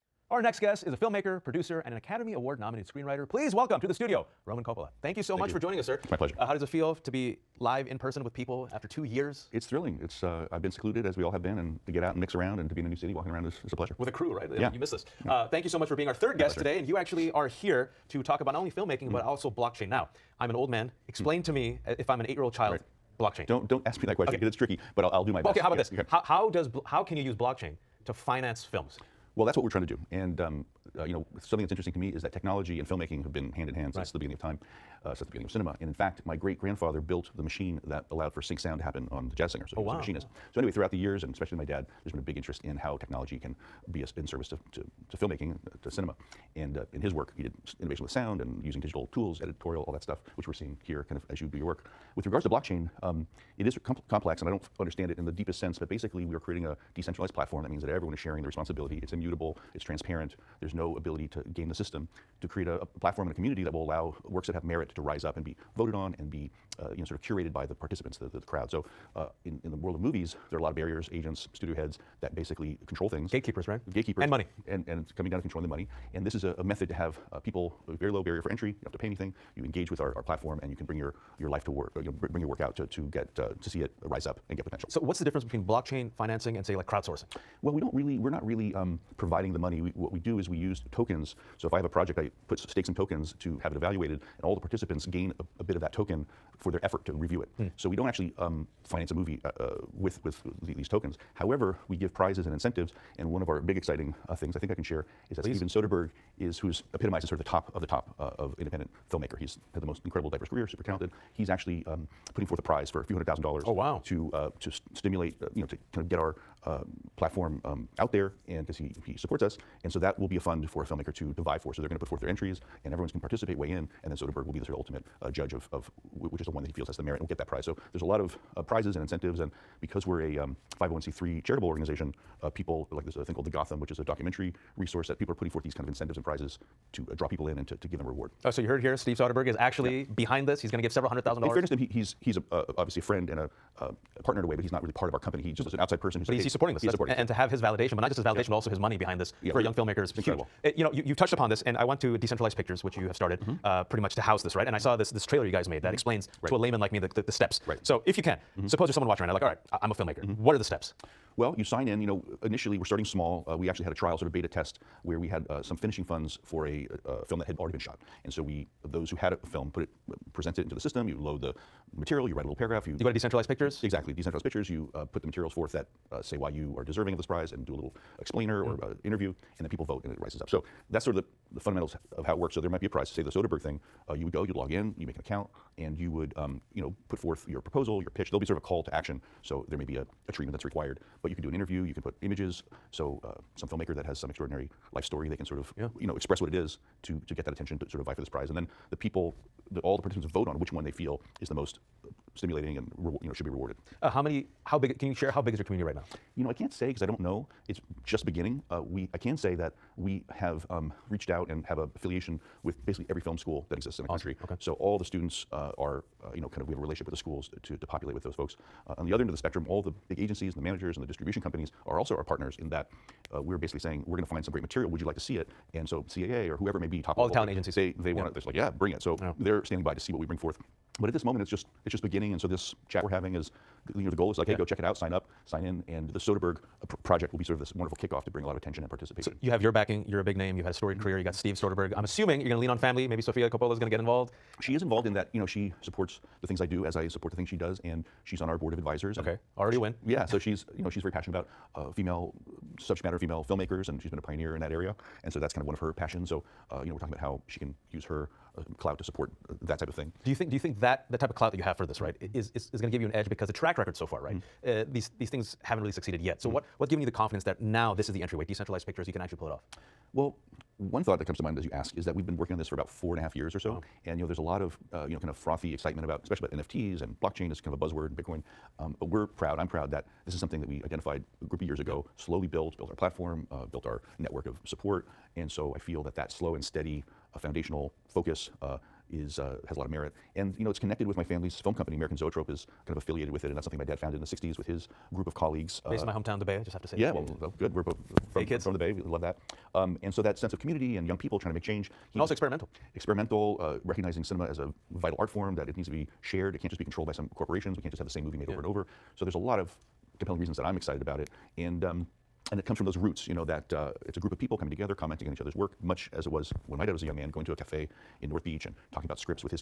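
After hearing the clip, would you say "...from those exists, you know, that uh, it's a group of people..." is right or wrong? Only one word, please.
wrong.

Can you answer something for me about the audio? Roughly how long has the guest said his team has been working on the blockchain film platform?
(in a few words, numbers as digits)
4 and a half years.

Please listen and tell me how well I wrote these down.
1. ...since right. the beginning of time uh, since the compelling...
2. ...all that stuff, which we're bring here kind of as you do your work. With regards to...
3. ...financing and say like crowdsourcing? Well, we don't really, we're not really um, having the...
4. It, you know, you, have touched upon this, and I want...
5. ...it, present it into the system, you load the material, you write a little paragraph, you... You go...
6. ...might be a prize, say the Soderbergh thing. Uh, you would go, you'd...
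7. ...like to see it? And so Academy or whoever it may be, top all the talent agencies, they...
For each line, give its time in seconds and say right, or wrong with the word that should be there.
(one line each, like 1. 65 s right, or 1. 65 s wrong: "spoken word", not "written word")
1. 33 s wrong: "beginning", not "compelling"
2. 49 s wrong: "seeing", not "bring"
3. 86 s wrong: "providing", not "having"
4. 150 s right
5. 169 s right
6. 182 s right
7. 225 s wrong: "CAA", not "Academy".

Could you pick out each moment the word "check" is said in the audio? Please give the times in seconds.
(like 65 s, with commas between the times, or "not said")
234 s.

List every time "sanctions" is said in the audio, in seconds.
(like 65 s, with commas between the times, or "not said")
not said.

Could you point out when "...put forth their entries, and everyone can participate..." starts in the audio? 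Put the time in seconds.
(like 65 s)
121 s.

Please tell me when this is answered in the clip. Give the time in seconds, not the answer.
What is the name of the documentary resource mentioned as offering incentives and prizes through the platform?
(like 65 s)
133 s.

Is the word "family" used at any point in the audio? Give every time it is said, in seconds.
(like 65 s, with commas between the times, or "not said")
242 s, 291 s.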